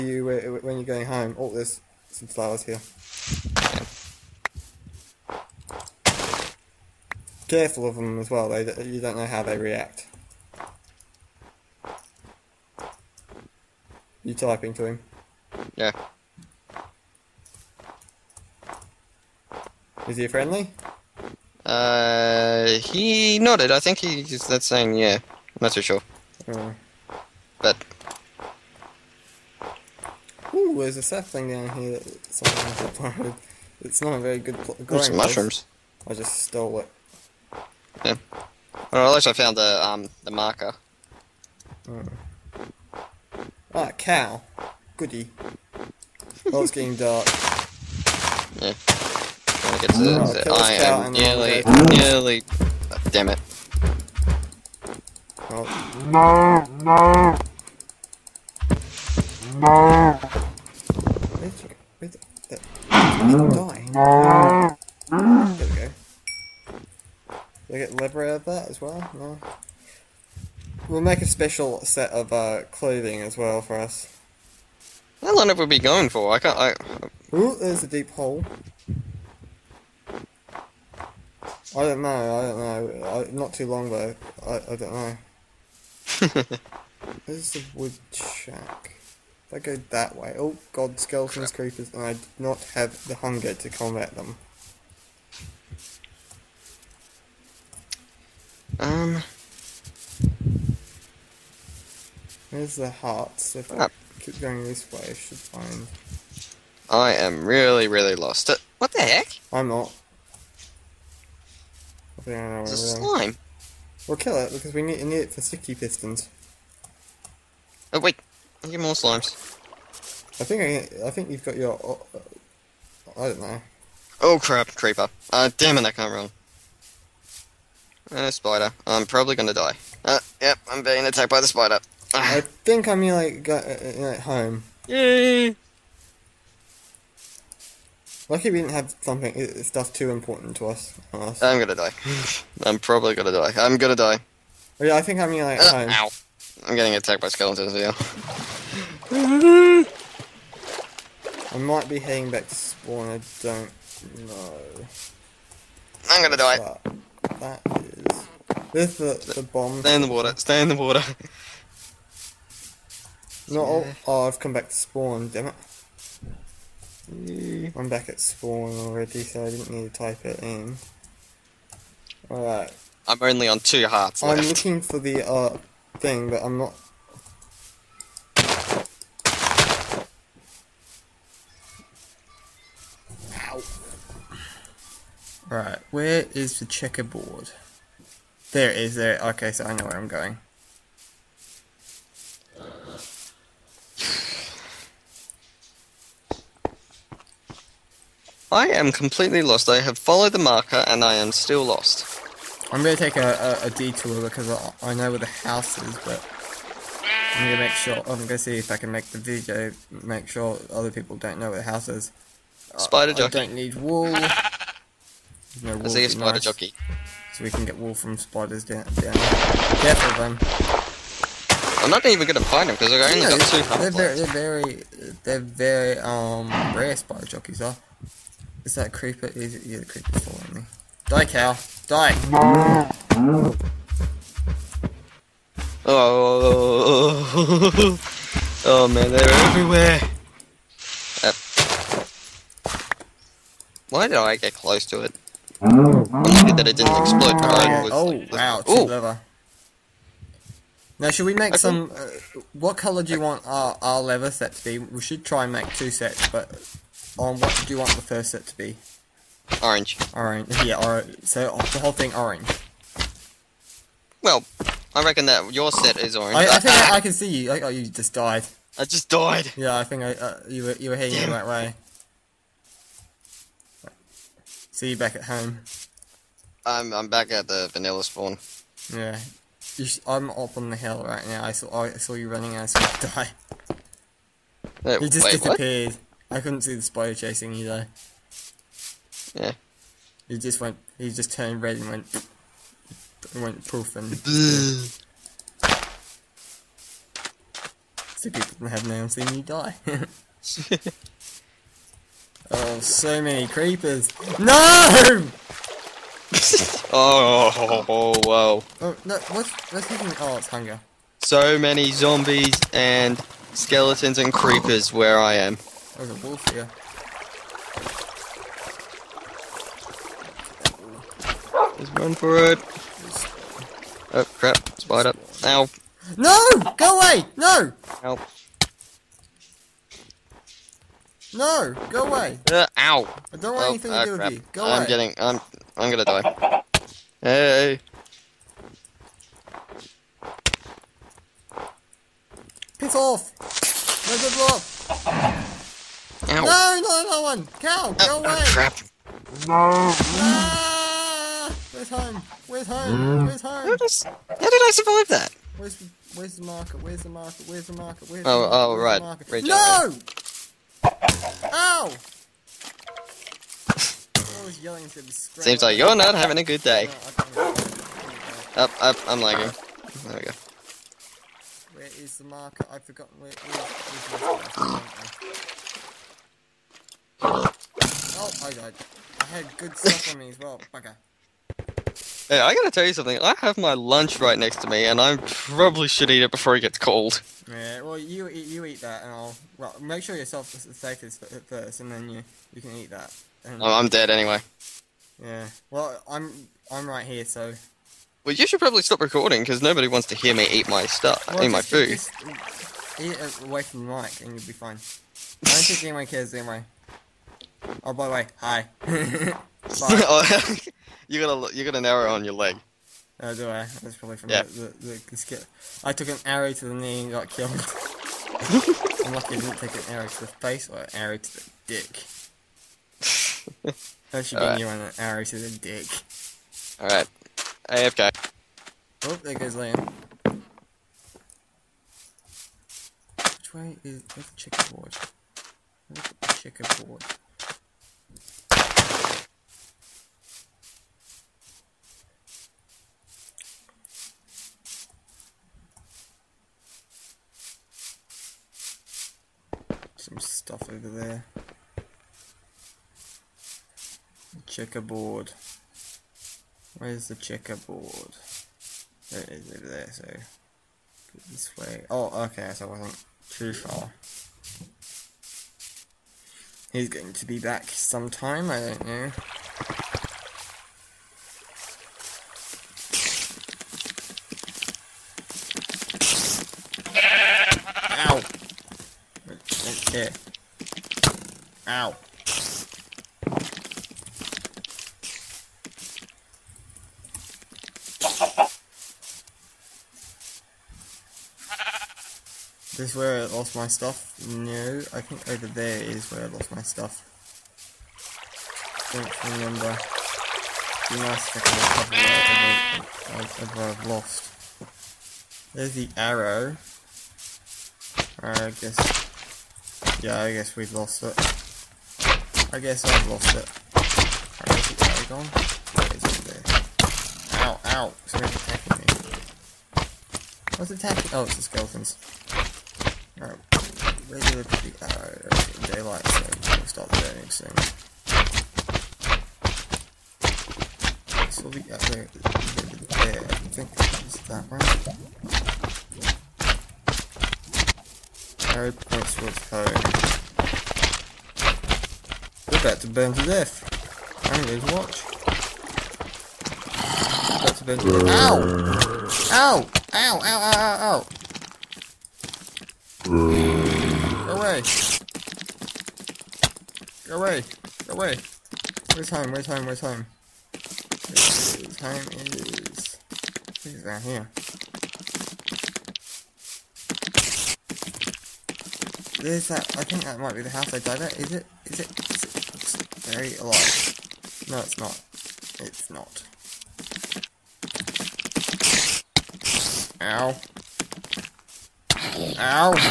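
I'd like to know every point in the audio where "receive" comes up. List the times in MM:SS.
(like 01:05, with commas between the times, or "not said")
not said.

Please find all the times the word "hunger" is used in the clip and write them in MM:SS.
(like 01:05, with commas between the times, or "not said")
01:33, 05:10.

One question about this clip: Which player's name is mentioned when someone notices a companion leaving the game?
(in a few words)
Liam.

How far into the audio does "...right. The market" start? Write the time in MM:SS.
05:59.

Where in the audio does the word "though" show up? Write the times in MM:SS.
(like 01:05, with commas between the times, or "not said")
01:23, 04:47.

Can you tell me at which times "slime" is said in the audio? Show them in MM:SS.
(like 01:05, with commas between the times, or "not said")
01:52, 01:58.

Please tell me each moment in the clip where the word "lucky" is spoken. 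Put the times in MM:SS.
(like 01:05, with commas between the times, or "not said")
02:18, 04:05, 06:59.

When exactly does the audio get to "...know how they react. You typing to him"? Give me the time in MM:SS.
00:09.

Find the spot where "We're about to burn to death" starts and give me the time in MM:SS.
09:02.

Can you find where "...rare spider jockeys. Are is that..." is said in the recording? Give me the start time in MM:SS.
03:46.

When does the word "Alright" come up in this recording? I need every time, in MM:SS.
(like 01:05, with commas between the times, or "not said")
02:52, 07:06.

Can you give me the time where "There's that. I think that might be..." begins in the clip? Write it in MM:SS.
09:29.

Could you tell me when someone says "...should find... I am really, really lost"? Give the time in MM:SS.
01:45.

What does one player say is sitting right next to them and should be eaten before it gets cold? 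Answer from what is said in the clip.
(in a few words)
lunch.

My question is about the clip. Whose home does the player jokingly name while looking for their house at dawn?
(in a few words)
Harry Potter.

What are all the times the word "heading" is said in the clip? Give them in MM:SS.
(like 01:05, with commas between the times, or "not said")
02:31, 04:30.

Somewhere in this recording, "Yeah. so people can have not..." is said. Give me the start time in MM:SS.
04:54.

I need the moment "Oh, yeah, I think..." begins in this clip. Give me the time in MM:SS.
02:24.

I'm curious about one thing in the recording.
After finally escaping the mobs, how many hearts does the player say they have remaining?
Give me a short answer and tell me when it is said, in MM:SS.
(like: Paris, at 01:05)
2, at 02:53.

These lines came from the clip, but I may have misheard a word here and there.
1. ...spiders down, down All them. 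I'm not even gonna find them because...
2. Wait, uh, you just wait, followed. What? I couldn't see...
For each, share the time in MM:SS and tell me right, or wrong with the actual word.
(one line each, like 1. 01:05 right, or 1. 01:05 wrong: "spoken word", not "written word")
1. 03:38 wrong: "Careful", not "All"
2. 04:44 wrong: "disappeared", not "followed".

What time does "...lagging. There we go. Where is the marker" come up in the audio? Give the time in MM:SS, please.
06:09.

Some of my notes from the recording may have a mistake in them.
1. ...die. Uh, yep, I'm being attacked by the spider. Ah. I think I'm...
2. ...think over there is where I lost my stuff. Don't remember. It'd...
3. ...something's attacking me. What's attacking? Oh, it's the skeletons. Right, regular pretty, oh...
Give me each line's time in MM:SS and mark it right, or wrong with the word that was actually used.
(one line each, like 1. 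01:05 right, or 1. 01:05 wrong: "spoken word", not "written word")
1. 02:09 right
2. 08:15 right
3. 08:38 right.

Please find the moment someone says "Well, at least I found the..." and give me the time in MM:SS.
00:38.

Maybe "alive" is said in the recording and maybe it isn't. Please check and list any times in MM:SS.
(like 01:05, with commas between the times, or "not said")
09:33.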